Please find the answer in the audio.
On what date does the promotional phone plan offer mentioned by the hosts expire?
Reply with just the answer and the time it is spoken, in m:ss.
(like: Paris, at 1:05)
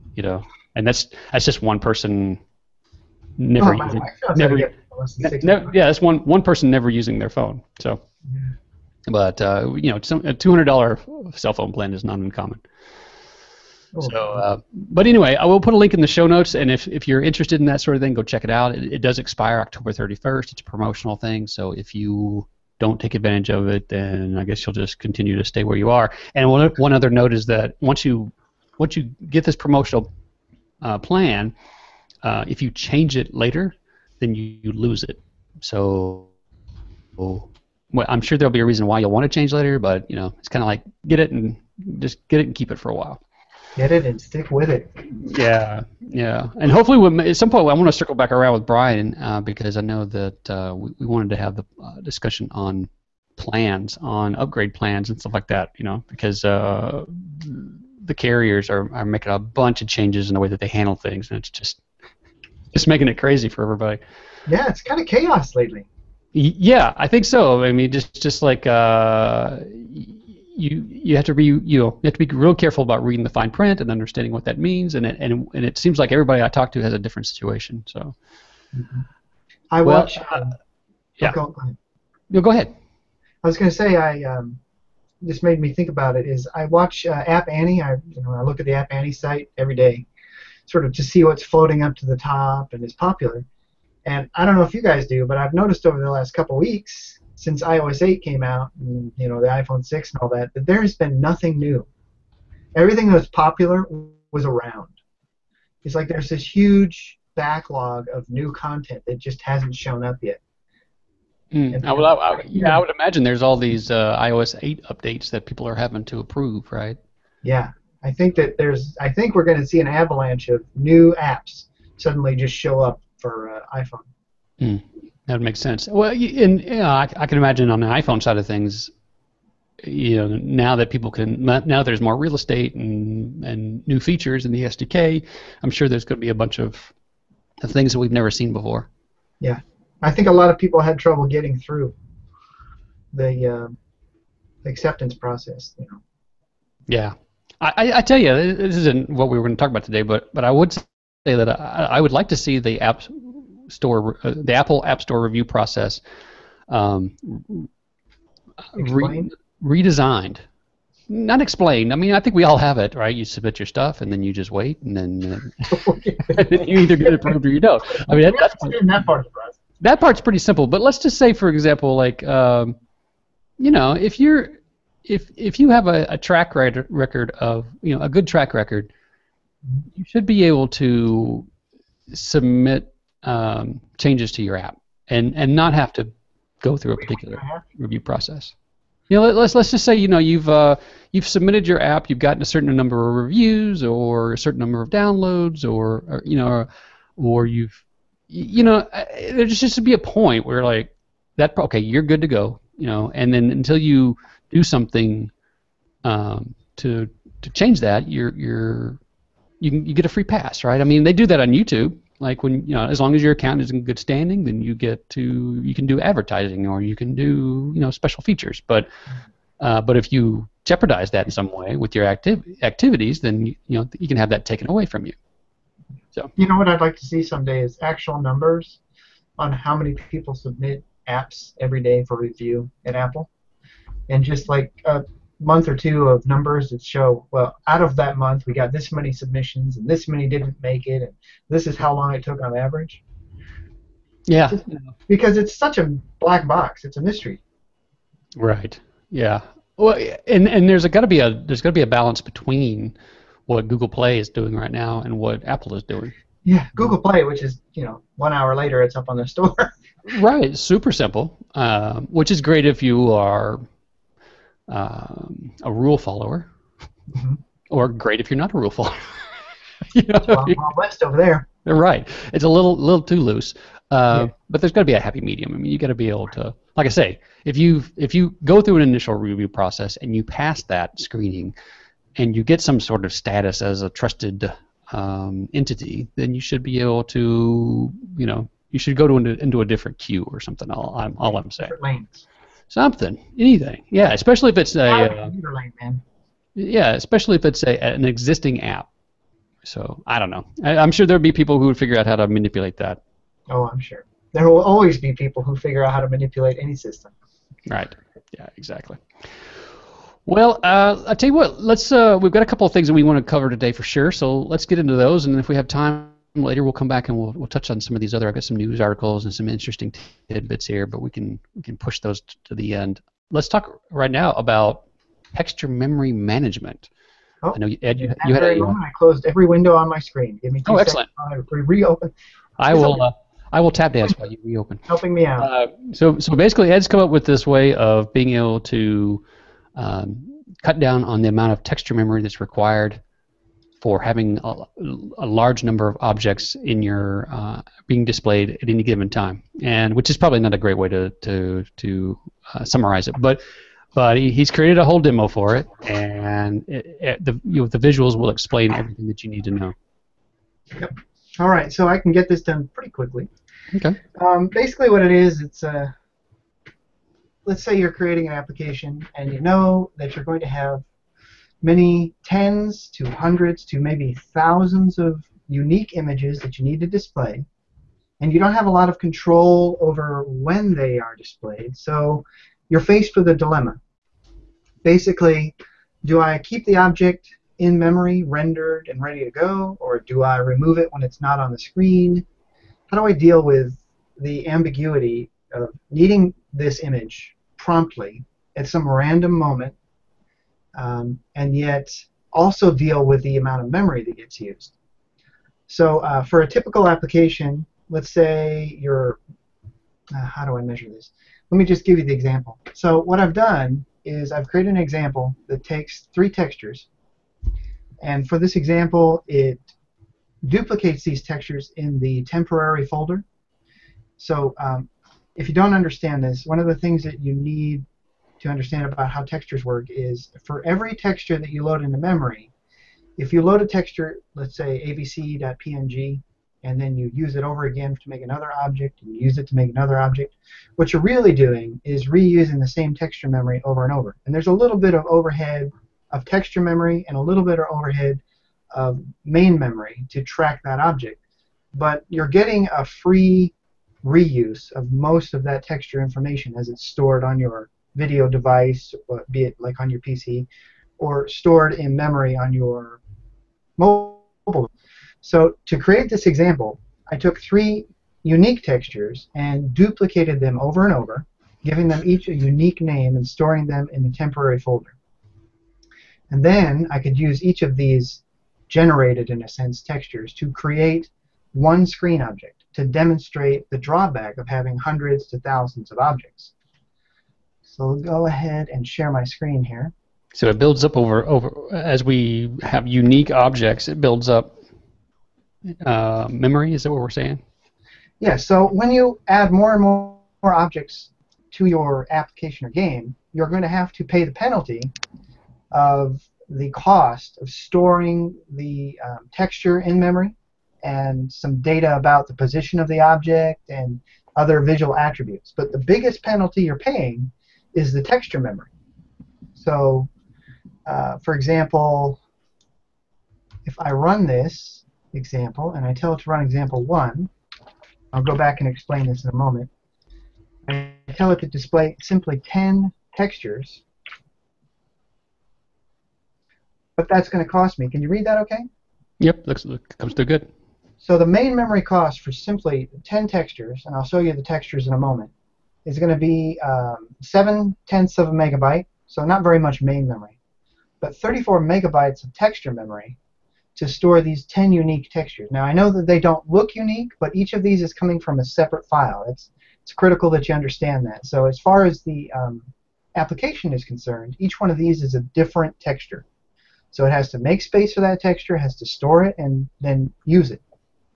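October 31st, at 0:19.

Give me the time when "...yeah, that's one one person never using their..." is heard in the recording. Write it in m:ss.
0:05.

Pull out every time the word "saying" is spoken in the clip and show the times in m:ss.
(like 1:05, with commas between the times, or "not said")
4:51, 8:17.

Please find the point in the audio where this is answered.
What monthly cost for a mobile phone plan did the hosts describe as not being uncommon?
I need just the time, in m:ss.
0:10.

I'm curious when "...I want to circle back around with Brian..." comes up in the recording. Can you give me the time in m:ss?
0:47.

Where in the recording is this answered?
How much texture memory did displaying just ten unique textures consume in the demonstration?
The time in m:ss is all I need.
9:11.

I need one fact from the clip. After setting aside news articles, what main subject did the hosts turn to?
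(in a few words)
texture memory management.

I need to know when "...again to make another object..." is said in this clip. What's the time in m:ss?
7:17.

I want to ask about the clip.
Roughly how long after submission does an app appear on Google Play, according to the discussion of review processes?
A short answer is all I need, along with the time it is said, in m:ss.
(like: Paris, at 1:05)
1 hour, at 4:18.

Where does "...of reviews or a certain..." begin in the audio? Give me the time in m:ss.
3:13.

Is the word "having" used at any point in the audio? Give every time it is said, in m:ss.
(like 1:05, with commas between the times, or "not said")
1:55, 5:44, 8:04.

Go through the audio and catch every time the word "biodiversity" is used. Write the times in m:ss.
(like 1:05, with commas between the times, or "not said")
not said.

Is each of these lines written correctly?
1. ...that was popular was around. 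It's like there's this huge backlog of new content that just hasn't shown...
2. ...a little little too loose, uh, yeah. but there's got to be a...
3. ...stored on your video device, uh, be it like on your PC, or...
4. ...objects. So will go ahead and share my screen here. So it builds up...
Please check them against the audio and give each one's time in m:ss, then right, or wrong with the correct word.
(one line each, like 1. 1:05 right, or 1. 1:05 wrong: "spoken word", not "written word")
1. 1:43 right
2. 4:32 right
3. 7:36 right
4. 8:05 right.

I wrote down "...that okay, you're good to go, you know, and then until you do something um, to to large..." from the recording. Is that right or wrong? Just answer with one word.
wrong.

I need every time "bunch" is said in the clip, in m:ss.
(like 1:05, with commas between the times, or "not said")
0:59, 2:16.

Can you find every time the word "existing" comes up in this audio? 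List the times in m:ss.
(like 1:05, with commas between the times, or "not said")
4:58.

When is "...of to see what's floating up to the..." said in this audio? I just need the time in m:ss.
1:30.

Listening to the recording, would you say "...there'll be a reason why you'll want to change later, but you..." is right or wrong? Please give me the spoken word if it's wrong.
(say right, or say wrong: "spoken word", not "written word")
right.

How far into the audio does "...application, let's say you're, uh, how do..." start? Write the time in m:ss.
6:46.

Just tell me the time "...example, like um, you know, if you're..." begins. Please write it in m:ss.
2:51.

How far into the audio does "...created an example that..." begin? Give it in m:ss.
6:54.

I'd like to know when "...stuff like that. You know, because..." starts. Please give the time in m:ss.
0:55.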